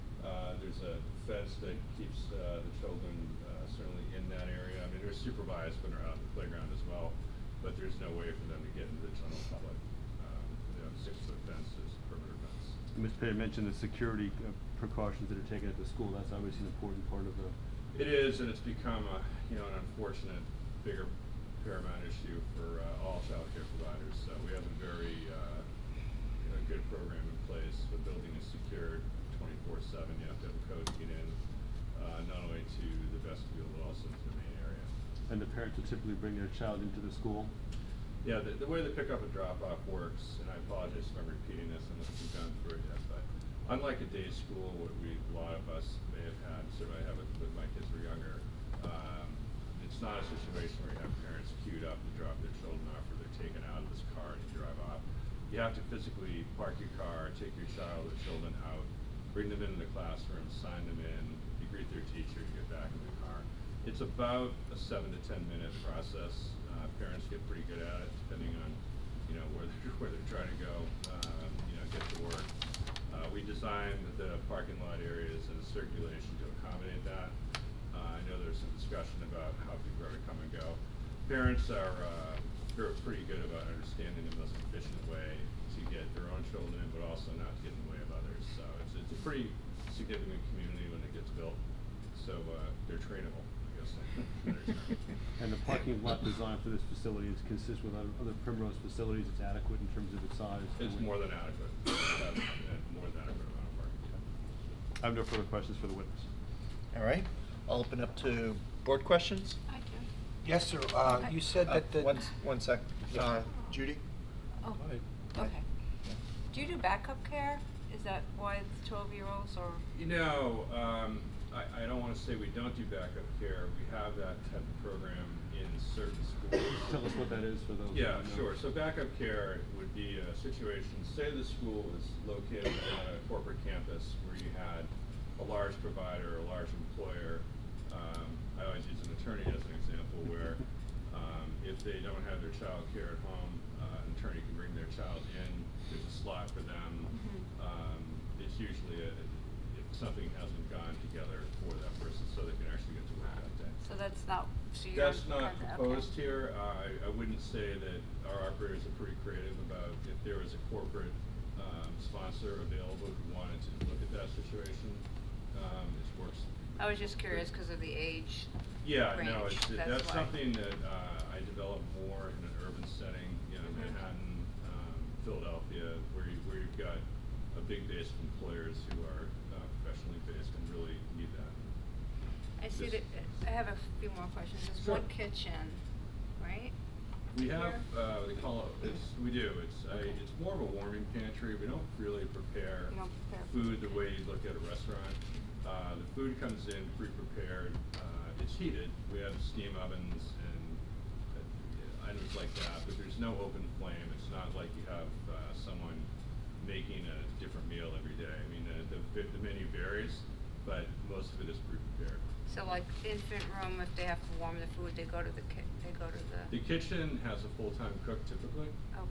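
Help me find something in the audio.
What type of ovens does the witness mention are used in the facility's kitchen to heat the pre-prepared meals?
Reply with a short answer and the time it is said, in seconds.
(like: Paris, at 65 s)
steam ovens, at 199 s.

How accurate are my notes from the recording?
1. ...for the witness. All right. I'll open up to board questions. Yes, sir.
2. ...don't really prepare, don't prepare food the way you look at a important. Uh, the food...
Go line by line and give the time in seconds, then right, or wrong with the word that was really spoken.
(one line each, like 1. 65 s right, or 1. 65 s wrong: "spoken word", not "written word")
1. 105 s right
2. 191 s wrong: "restaurant", not "important".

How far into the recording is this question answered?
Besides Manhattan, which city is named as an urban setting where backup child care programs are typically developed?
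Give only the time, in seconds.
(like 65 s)
175 s.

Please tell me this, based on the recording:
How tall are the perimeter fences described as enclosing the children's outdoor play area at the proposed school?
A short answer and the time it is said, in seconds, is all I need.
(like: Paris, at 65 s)
six-foot, at 11 s.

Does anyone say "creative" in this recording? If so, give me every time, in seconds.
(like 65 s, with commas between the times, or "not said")
159 s.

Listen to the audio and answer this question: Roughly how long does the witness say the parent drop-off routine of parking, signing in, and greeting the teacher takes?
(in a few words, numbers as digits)
7 to 10 minutes.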